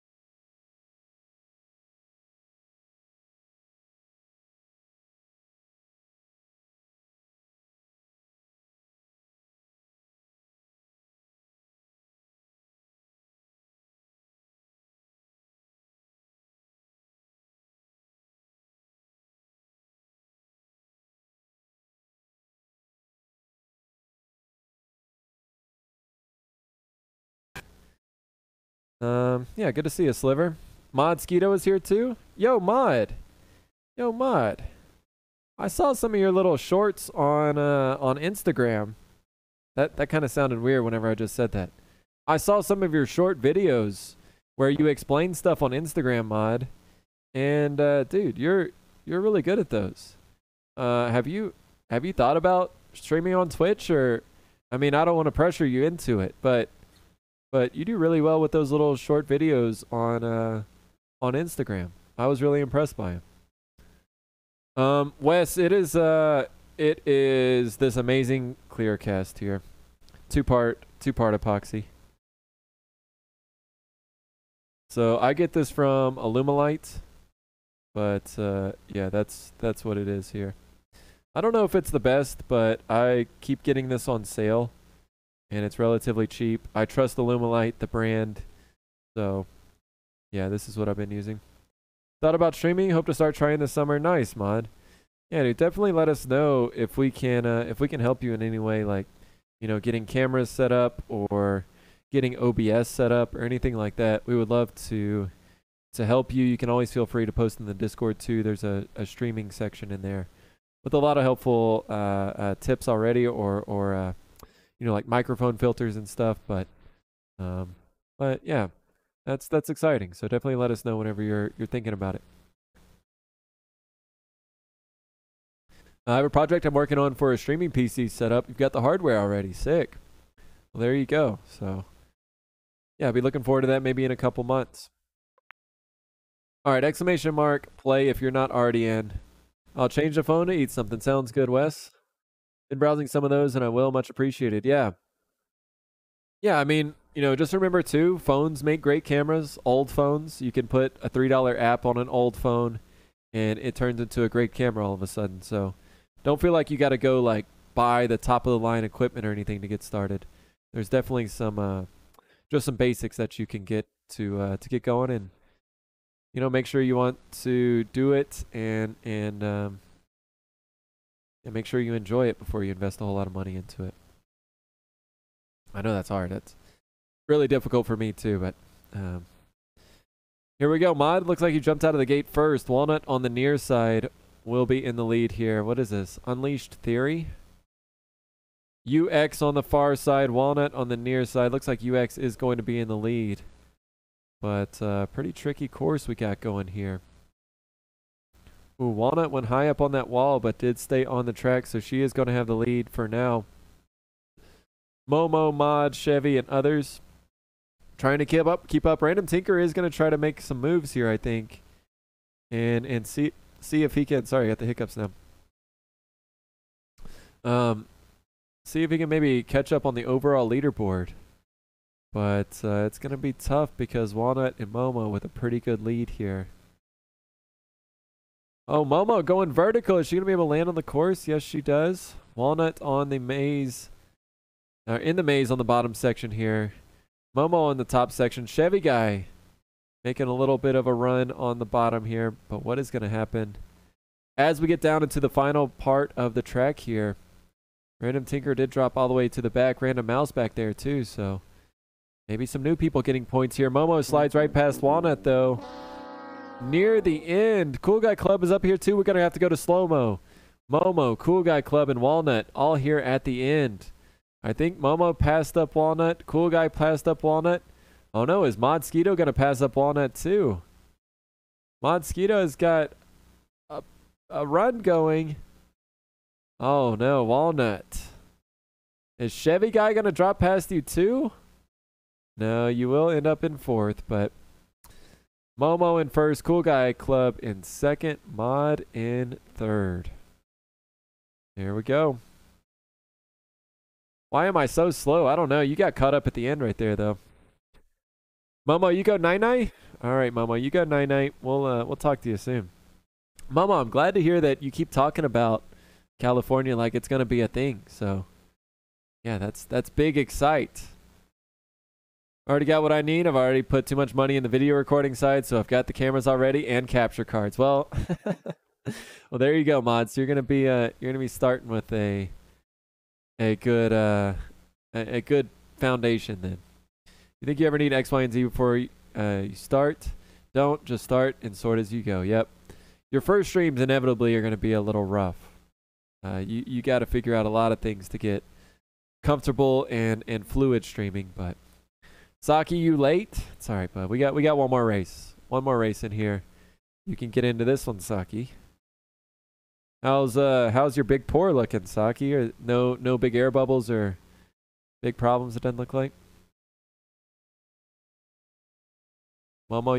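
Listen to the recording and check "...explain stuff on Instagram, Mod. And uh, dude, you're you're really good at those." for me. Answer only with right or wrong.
right.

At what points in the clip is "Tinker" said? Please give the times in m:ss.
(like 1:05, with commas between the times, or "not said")
3:29, 4:08.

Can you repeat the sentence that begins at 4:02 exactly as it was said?
But what is going to happen?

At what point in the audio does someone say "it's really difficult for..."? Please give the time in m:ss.
2:56.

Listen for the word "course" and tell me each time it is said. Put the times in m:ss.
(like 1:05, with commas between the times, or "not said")
3:15, 3:50.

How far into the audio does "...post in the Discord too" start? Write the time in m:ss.
1:47.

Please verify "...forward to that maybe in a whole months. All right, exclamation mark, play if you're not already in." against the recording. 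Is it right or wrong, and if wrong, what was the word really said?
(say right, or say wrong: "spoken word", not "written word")
wrong: "couple", not "whole".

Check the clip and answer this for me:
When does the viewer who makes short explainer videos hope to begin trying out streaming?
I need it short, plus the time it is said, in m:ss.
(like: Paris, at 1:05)
This summer, at 1:33.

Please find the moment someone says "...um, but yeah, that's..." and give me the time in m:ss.
1:57.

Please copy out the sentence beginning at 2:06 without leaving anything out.
I have a project I'm working on for a streaming PC setup.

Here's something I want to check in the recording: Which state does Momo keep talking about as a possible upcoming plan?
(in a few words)
California.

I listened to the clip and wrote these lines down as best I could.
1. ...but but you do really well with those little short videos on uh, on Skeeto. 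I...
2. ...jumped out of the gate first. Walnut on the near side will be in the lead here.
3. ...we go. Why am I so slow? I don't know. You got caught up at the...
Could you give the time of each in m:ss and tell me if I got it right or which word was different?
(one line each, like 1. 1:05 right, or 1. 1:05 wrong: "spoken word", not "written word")
1. 0:56 wrong: "Instagram", not "Skeeto"
2. 3:01 right
3. 4:51 right.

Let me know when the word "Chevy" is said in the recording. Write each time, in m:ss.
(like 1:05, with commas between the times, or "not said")
3:25, 3:58, 4:39.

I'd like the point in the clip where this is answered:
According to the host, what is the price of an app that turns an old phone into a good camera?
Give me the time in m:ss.
2:31.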